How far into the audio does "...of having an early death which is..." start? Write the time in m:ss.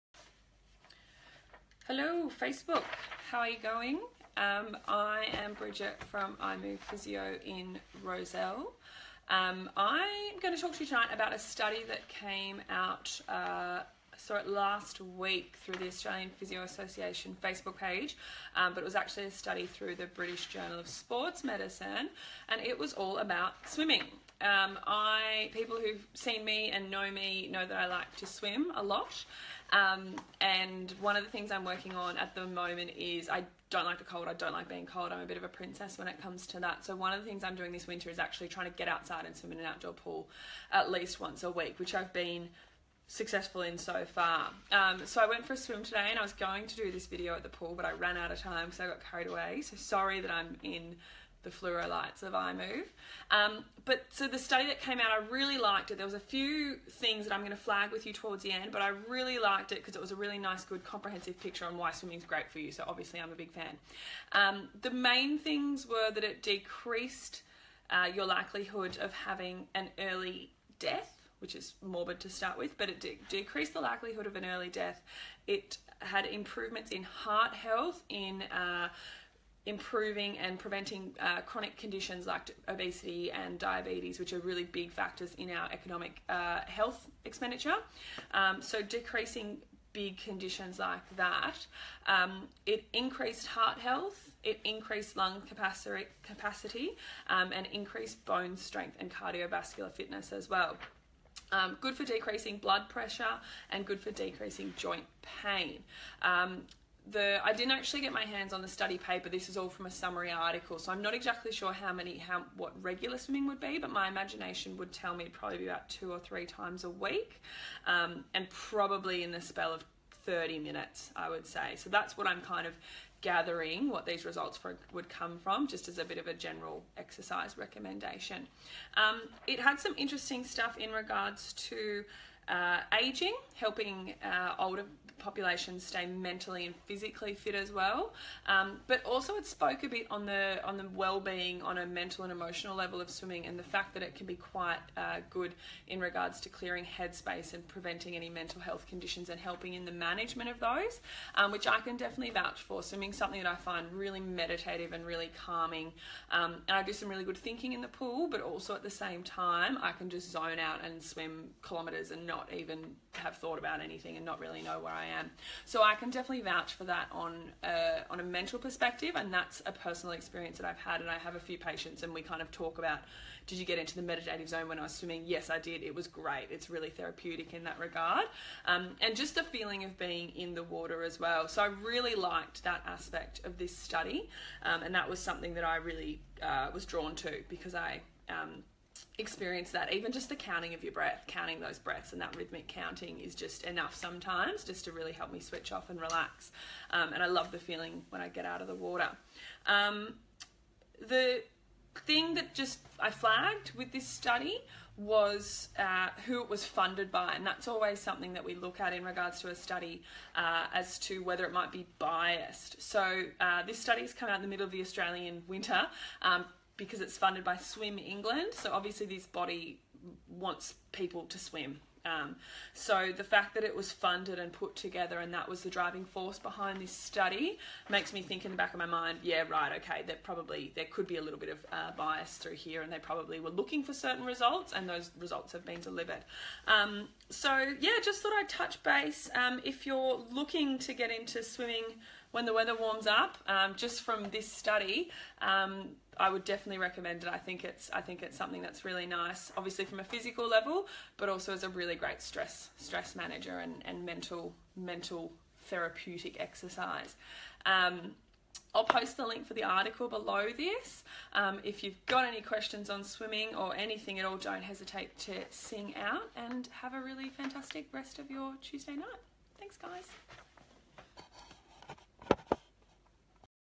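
1:09.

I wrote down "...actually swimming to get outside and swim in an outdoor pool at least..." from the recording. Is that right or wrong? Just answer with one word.
wrong.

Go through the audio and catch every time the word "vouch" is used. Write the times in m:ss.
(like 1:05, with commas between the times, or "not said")
2:32, 2:46.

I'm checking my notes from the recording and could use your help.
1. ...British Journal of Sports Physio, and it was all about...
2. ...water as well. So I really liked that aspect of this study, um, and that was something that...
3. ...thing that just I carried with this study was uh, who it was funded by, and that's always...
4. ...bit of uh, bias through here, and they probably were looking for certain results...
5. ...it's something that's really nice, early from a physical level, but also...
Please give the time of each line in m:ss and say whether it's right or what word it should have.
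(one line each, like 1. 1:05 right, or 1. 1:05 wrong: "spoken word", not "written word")
1. 0:20 wrong: "Medicine", not "Physio"
2. 3:00 right
3. 3:22 wrong: "flagged", not "carried"
4. 3:51 right
5. 4:08 wrong: "obviously", not "early".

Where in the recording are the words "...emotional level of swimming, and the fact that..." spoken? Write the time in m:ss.
2:22.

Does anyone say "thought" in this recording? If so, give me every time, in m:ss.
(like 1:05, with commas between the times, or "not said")
2:43, 3:58.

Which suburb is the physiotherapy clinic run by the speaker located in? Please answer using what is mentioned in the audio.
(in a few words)
Rozelle.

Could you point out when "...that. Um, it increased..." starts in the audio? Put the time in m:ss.
1:31.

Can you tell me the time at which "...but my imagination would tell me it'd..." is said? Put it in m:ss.
1:53.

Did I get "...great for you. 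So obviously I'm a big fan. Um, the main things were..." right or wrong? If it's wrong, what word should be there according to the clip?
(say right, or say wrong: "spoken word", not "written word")
right.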